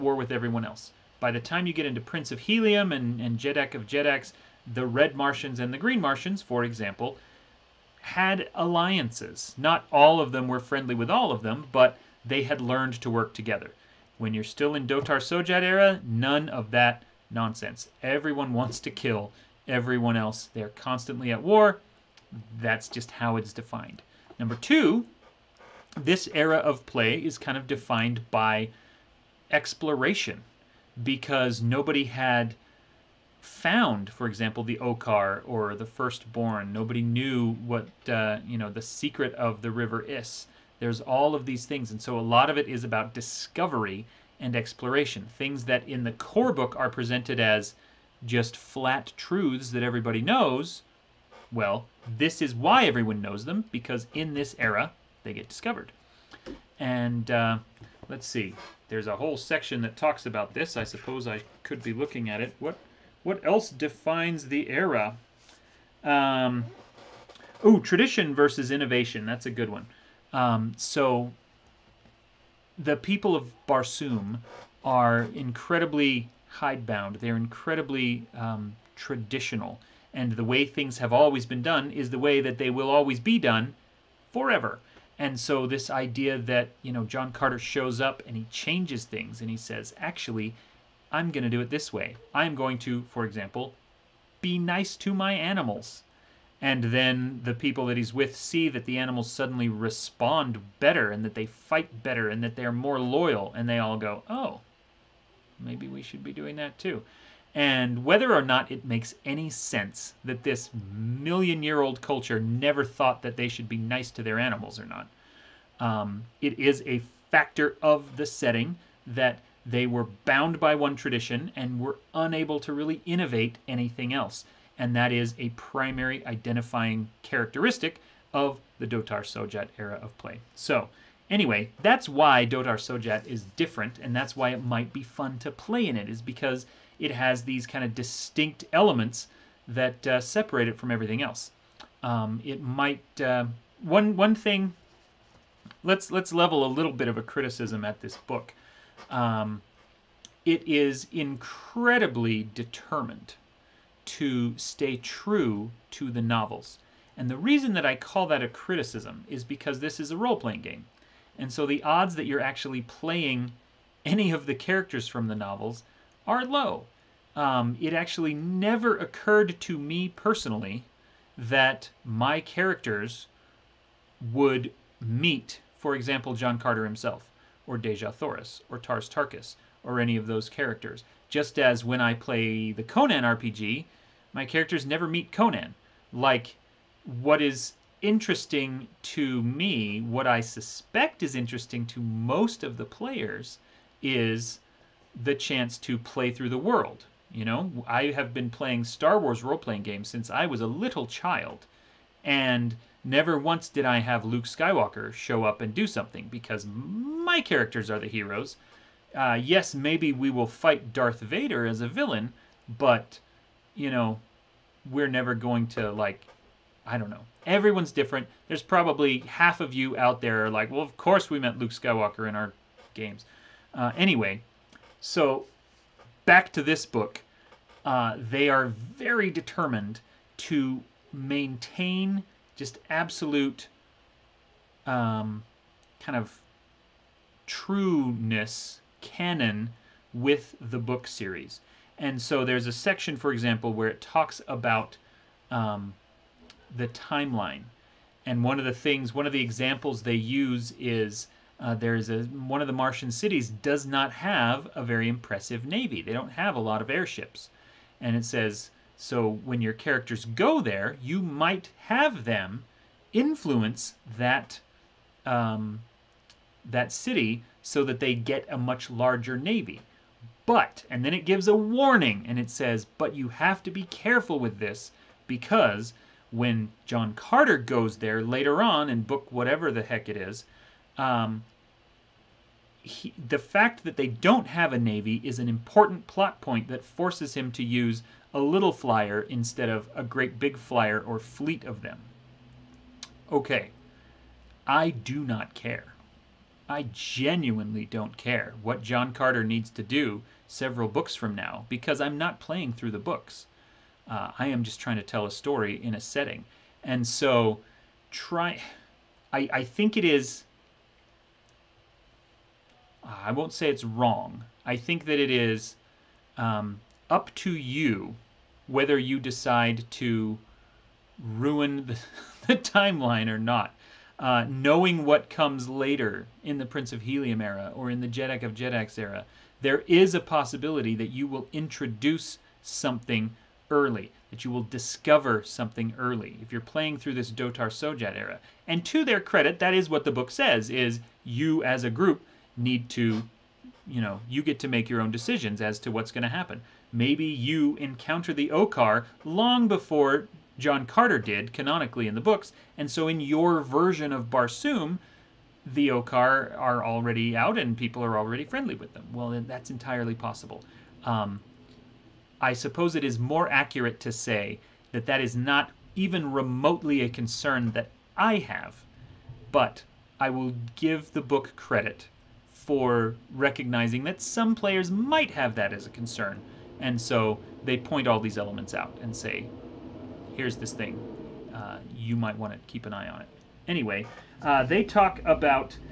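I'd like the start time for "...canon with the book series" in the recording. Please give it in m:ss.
3:59.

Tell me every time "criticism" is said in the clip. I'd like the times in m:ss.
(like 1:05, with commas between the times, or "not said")
2:27, 2:38.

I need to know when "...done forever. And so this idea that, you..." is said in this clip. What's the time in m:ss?
1:23.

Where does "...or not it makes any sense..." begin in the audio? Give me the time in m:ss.
1:48.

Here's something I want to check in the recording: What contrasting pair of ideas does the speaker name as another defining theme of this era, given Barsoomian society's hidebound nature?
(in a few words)
tradition versus innovation.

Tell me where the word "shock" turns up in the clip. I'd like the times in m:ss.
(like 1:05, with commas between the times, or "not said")
not said.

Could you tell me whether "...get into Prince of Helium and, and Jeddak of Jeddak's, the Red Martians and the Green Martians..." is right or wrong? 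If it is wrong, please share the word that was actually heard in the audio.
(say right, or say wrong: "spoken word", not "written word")
right.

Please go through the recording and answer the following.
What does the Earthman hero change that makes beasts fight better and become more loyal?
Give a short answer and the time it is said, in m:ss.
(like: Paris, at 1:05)
be nice to my animals, at 1:34.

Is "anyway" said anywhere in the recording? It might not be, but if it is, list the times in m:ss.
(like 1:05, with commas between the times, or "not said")
2:11, 3:43, 6:23.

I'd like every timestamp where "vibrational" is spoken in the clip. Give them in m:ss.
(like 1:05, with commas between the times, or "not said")
not said.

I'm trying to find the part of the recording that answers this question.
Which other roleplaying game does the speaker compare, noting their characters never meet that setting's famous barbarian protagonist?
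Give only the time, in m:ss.
3:02.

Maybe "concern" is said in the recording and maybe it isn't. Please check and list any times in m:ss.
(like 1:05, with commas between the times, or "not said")
6:07, 6:15.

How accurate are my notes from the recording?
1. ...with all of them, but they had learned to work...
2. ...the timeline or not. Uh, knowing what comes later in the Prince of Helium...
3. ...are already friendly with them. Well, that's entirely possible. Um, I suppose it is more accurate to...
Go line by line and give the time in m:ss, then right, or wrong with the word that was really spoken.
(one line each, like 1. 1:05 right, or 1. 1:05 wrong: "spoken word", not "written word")
1. 0:10 right
2. 5:22 right
3. 5:58 right.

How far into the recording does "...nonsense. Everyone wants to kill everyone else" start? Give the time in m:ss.
0:17.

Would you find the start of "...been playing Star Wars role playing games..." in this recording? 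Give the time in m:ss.
3:18.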